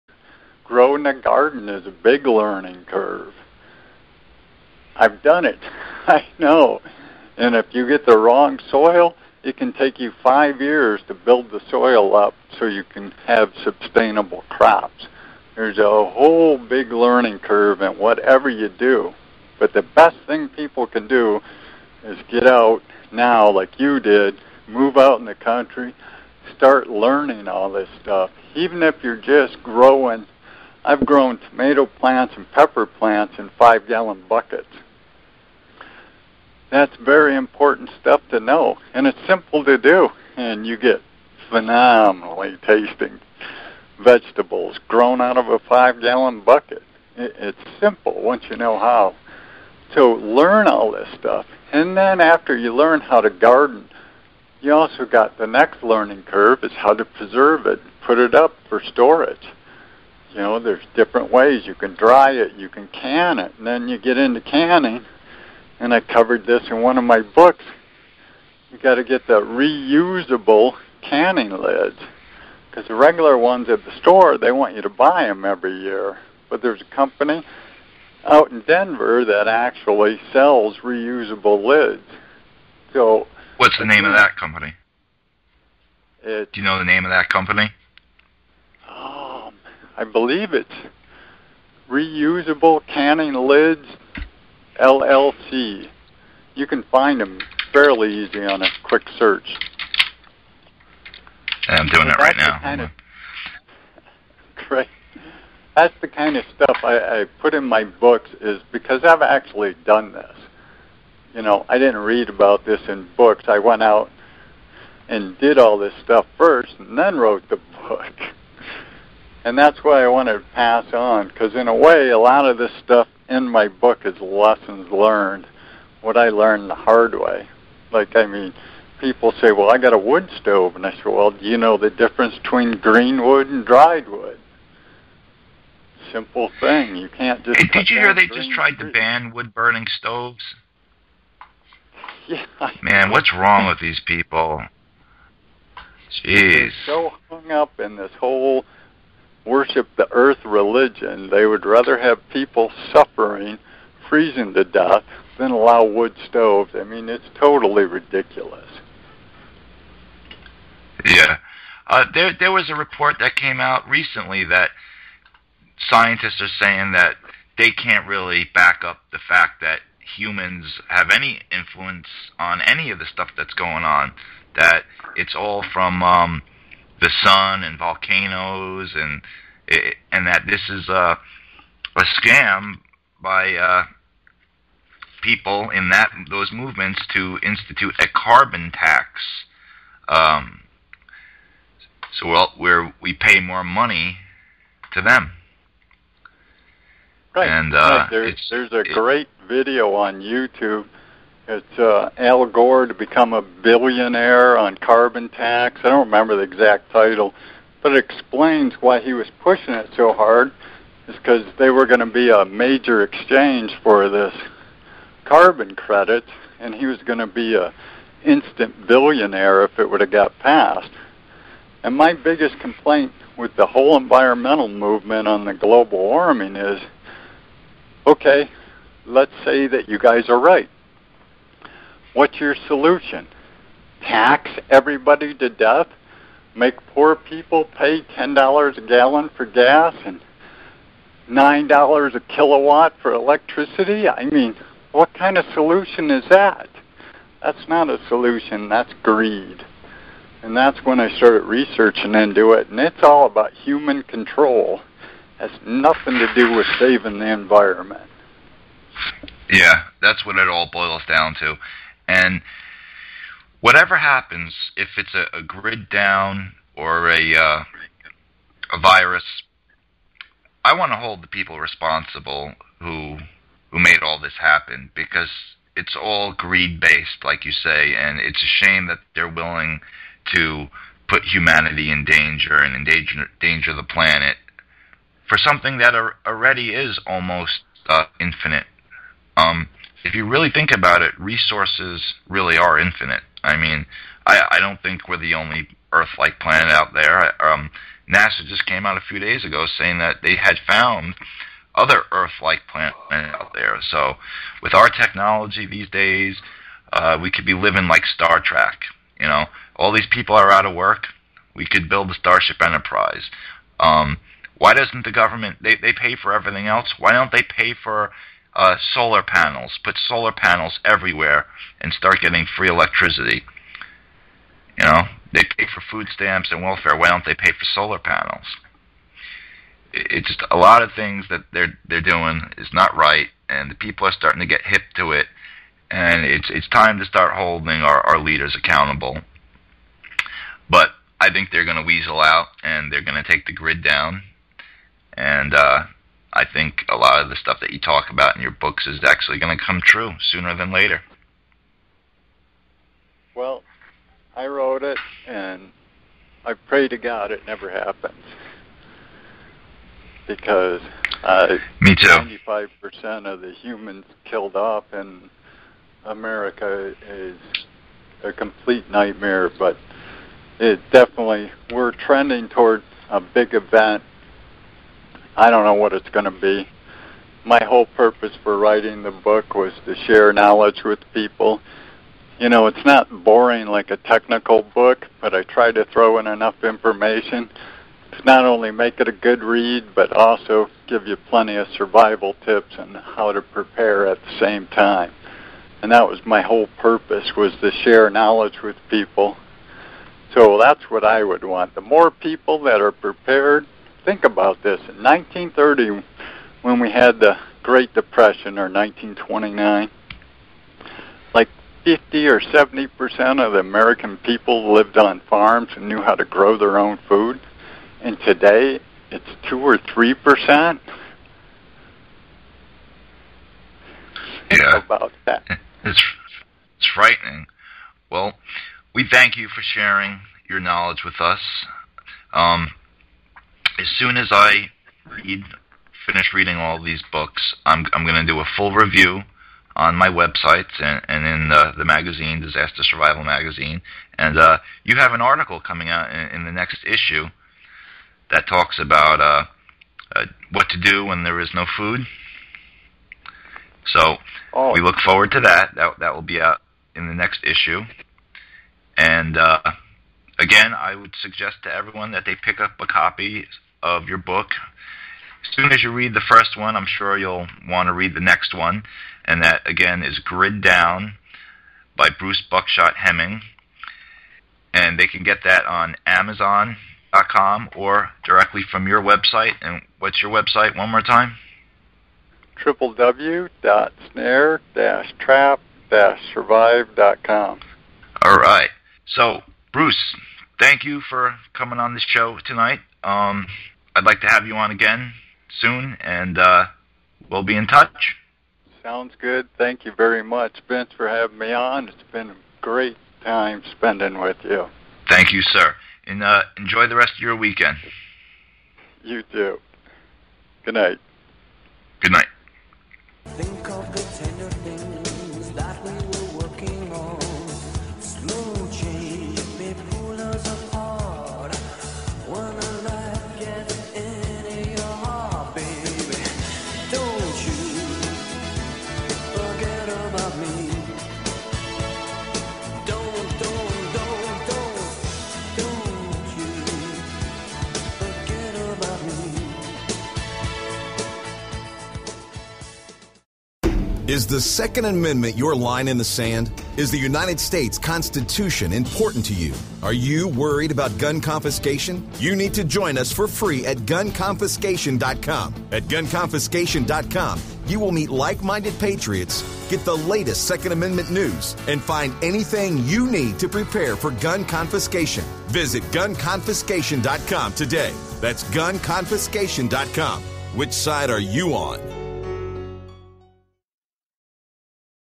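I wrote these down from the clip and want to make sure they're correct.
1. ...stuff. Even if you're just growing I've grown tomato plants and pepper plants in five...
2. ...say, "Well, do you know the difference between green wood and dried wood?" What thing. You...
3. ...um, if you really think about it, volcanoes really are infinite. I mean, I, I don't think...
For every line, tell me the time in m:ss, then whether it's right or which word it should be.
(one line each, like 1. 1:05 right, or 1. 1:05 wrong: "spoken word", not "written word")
1. 0:28 right
2. 2:10 wrong: "Simple", not "What"
3. 4:49 wrong: "resources", not "volcanoes".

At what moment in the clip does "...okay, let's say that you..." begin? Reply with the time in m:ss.
3:48.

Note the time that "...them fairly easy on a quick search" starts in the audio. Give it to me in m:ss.
1:37.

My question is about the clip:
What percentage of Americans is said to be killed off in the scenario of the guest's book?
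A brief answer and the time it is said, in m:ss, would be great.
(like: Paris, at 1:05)
95 percent, at 6:02.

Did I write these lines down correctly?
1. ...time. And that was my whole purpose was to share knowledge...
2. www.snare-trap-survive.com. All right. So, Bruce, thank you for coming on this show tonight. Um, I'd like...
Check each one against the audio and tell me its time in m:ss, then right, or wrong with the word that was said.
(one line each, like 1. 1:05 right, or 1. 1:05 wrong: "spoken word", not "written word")
1. 6:34 right
2. 8:02 right.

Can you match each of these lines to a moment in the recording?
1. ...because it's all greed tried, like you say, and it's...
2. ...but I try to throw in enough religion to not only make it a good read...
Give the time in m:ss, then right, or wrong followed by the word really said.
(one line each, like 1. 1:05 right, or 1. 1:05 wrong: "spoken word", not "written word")
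1. 4:34 wrong: "based", not "tried"
2. 6:25 wrong: "information", not "religion".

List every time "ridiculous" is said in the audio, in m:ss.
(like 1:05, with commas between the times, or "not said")
2:37.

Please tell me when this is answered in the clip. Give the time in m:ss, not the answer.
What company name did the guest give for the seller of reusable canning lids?
1:31.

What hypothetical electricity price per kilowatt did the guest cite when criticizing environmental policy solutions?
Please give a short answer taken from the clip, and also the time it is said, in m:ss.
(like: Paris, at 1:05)
$9, at 4:01.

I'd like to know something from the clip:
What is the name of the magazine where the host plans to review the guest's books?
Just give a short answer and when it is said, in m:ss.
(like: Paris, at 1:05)
Disaster Survival Magazine, at 7:22.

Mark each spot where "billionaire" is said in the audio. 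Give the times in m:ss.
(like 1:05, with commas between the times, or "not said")
3:23, 3:38.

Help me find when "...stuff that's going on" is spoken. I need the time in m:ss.
2:53.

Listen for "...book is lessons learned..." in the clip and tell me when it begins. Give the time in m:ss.
2:03.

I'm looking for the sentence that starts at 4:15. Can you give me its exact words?
has nothing to do with saving the environment.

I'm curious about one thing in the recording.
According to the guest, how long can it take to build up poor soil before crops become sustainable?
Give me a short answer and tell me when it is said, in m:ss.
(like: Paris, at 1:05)
5 years, at 0:10.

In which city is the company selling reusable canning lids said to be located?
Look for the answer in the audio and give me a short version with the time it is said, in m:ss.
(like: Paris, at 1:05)
Denver, at 1:18.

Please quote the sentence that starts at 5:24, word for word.
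You know, they pay for food stamps and welfare.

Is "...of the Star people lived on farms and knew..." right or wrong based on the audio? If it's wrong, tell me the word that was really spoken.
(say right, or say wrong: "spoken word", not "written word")
wrong: "American", not "Star".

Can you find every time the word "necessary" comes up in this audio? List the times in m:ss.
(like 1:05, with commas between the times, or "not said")
not said.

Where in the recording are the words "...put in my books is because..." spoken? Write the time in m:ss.
1:47.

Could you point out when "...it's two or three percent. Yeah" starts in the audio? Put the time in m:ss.
6:59.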